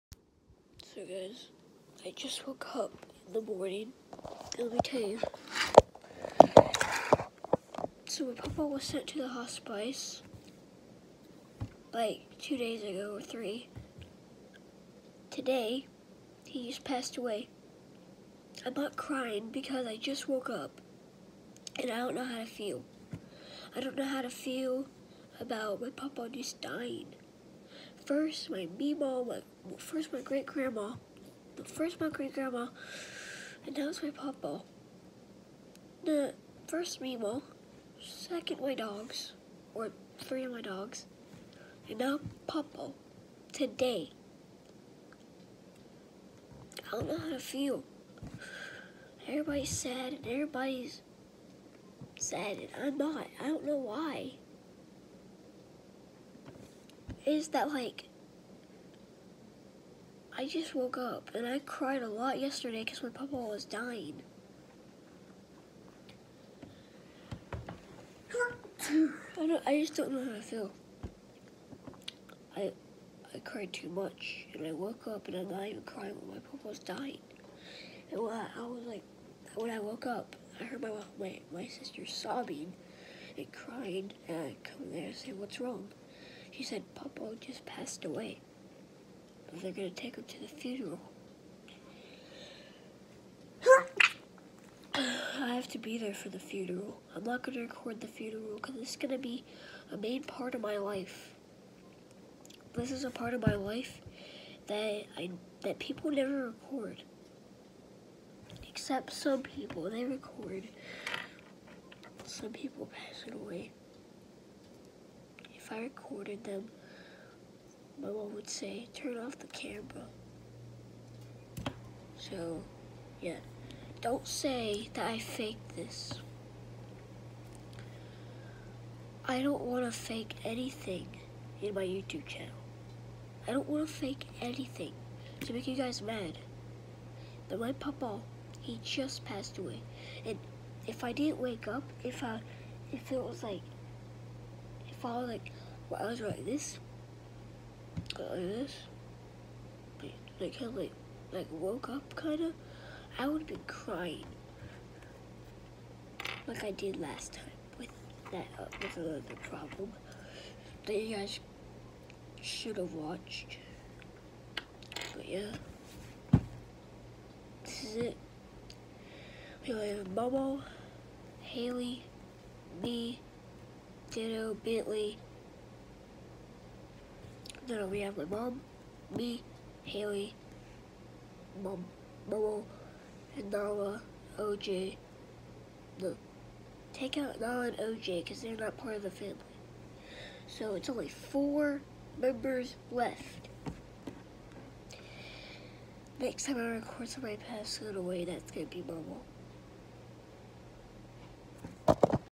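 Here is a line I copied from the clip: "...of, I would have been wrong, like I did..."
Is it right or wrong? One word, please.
wrong.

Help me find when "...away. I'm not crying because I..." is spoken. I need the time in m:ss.
0:17.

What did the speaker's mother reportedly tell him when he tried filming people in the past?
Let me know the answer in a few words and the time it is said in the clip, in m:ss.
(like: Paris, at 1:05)
Turn off the camera, at 1:58.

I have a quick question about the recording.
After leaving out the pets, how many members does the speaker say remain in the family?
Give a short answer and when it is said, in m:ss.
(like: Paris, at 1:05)
4, at 3:11.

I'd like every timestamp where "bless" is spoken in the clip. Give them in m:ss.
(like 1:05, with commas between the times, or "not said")
not said.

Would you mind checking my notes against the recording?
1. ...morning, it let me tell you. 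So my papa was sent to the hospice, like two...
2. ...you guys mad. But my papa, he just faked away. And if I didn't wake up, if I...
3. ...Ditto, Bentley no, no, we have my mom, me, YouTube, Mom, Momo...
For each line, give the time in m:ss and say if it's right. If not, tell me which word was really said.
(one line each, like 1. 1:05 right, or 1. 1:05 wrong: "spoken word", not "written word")
1. 0:03 right
2. 2:15 wrong: "passed", not "faked"
3. 2:54 wrong: "Haley", not "YouTube".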